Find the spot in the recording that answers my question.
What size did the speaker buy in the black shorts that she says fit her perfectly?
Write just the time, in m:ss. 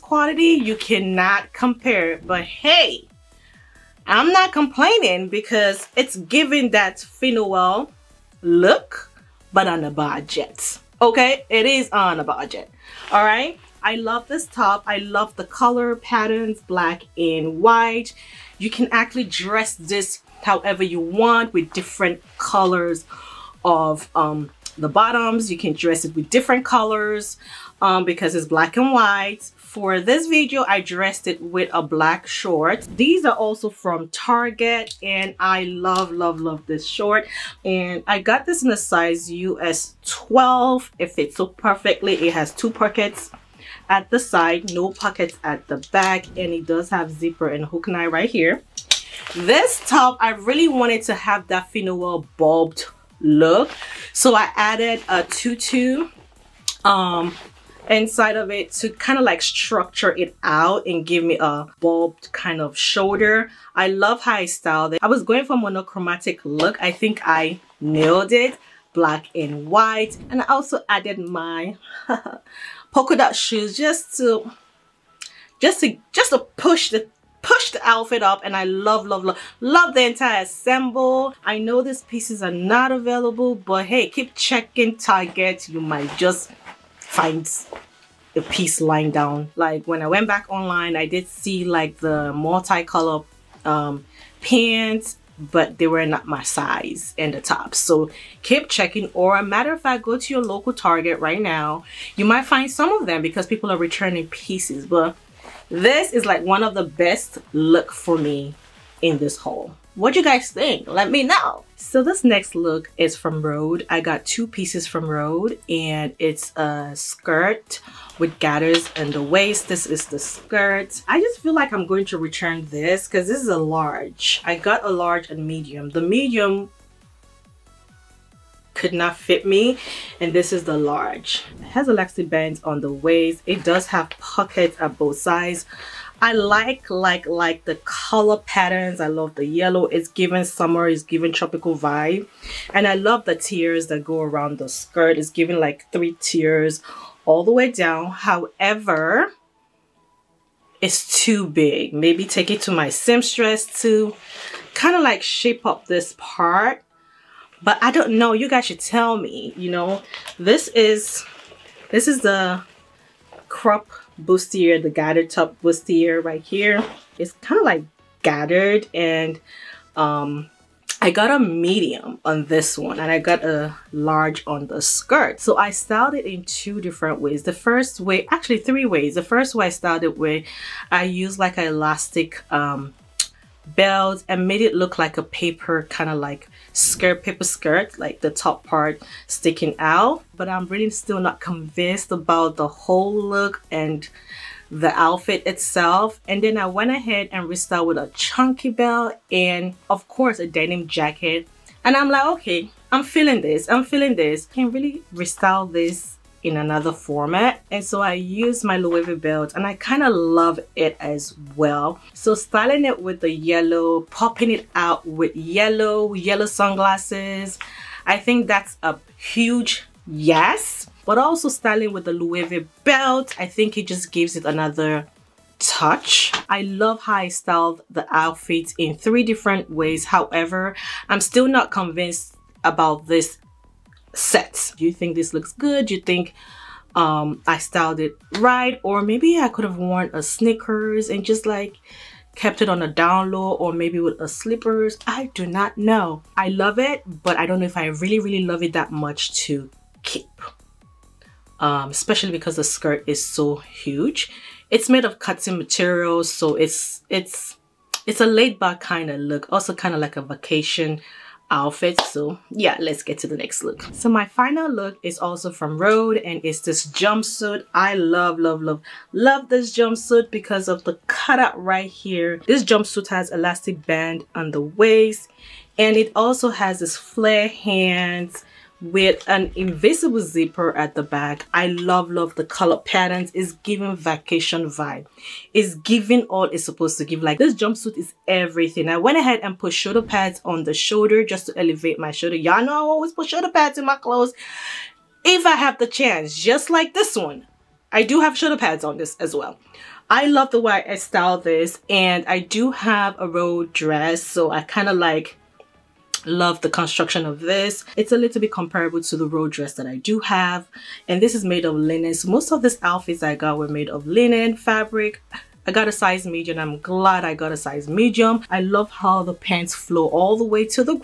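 0:39.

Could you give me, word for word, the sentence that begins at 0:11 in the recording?
Okay, it is on a budget.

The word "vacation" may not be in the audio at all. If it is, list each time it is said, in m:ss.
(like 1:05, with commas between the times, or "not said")
4:20, 4:43.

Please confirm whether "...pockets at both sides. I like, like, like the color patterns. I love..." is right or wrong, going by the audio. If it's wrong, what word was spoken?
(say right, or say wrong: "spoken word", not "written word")
right.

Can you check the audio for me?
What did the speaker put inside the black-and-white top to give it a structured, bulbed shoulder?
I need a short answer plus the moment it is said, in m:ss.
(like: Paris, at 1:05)
A tutu, at 0:55.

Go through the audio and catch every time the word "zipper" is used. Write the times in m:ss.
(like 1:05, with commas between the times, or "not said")
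0:47, 4:40.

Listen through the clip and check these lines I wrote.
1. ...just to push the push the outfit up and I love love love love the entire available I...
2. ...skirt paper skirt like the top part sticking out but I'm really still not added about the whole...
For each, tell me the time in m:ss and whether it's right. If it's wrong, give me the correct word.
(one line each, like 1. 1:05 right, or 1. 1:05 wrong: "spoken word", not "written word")
1. 1:16 wrong: "ensemble", not "available"
2. 3:06 wrong: "convinced", not "added".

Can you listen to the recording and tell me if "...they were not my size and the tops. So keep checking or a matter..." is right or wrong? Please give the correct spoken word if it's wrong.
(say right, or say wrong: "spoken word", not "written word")
right.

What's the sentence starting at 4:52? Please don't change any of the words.
Y'all know I always put shoulder pads in my clothes if I have the chance, just like this one.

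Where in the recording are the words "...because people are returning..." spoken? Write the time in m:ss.
1:43.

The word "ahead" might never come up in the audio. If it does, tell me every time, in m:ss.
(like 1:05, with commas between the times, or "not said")
3:16, 4:49.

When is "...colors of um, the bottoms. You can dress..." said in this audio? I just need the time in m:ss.
0:22.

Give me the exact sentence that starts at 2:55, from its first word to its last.
So I styled it in two different ways.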